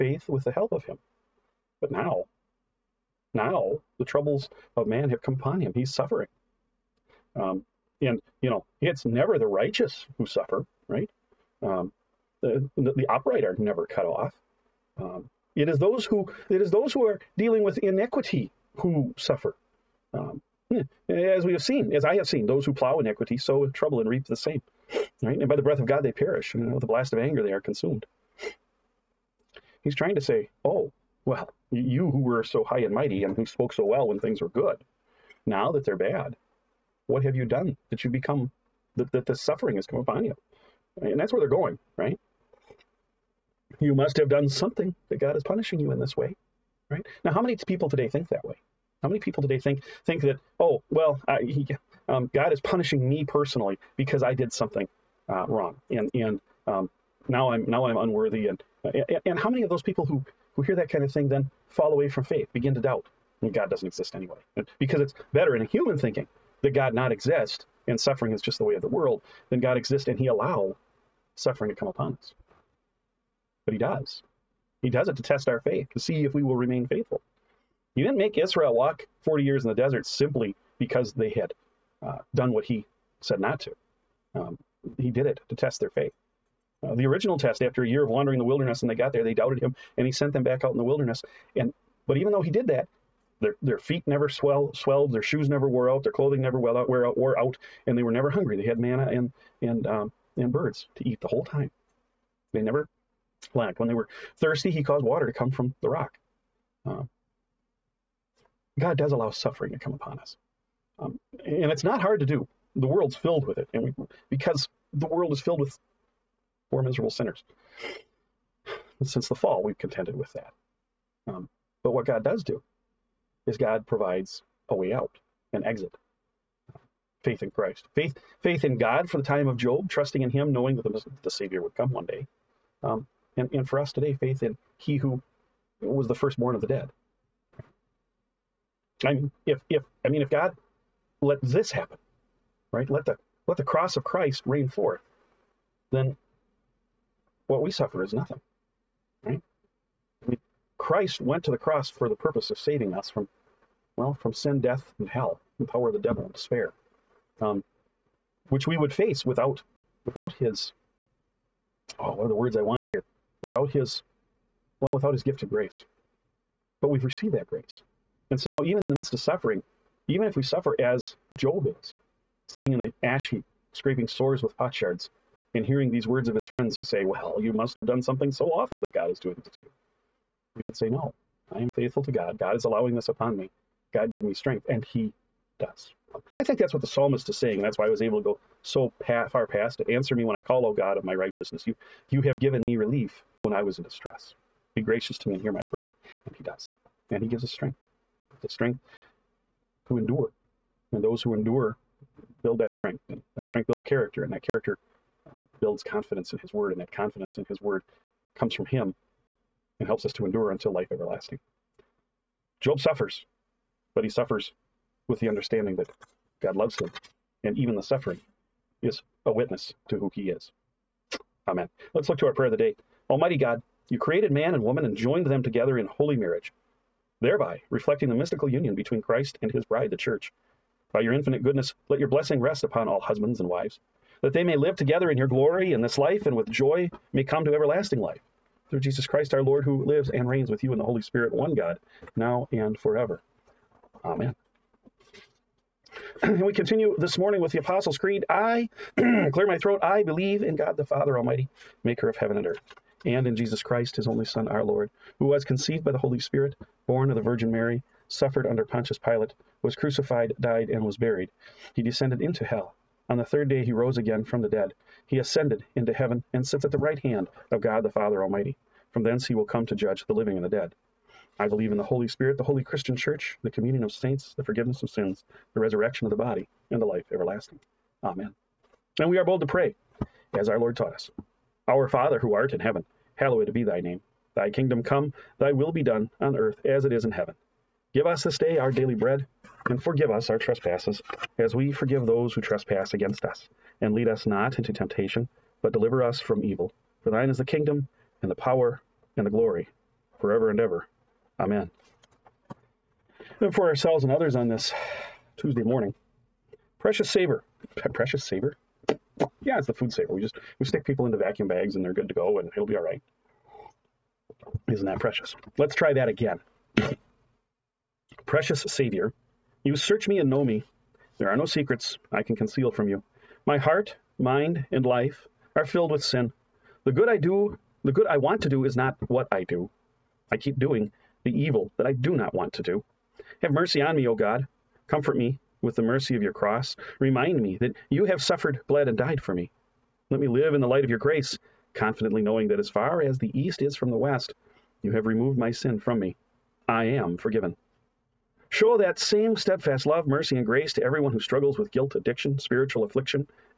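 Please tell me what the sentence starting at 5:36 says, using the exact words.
Remind me that you have suffered, bled, and died for me.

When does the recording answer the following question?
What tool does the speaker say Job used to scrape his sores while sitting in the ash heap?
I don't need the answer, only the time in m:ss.
2:54.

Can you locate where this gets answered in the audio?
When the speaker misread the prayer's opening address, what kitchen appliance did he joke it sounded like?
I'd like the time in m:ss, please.
5:09.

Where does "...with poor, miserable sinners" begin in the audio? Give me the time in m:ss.
1:55.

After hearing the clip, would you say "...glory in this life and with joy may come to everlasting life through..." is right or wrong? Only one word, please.
right.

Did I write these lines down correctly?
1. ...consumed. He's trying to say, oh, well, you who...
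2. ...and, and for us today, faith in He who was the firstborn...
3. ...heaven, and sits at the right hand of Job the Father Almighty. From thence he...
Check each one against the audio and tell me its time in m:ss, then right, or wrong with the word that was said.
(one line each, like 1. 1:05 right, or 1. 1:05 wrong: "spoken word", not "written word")
1. 0:27 right
2. 2:13 right
3. 4:25 wrong: "God", not "Job".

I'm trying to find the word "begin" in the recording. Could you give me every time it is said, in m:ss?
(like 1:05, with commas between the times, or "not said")
1:02.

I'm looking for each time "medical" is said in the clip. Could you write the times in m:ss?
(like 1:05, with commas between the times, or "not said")
not said.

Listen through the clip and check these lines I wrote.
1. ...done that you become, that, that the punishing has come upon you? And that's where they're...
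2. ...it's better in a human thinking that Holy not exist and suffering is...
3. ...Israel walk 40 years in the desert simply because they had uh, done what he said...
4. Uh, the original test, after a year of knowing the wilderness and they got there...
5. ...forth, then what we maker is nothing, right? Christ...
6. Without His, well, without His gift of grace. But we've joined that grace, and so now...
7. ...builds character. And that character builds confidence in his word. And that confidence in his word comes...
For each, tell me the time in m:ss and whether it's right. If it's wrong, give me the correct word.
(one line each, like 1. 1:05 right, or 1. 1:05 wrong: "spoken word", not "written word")
1. 0:37 wrong: "suffering", not "punishing"
2. 1:04 wrong: "God", not "Holy"
3. 1:18 right
4. 1:26 wrong: "wandering", not "knowing"
5. 2:24 wrong: "suffer", not "maker"
6. 2:43 wrong: "received", not "joined"
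7. 3:23 right.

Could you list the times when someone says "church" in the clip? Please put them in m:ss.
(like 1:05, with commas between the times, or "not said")
3:49, 4:32.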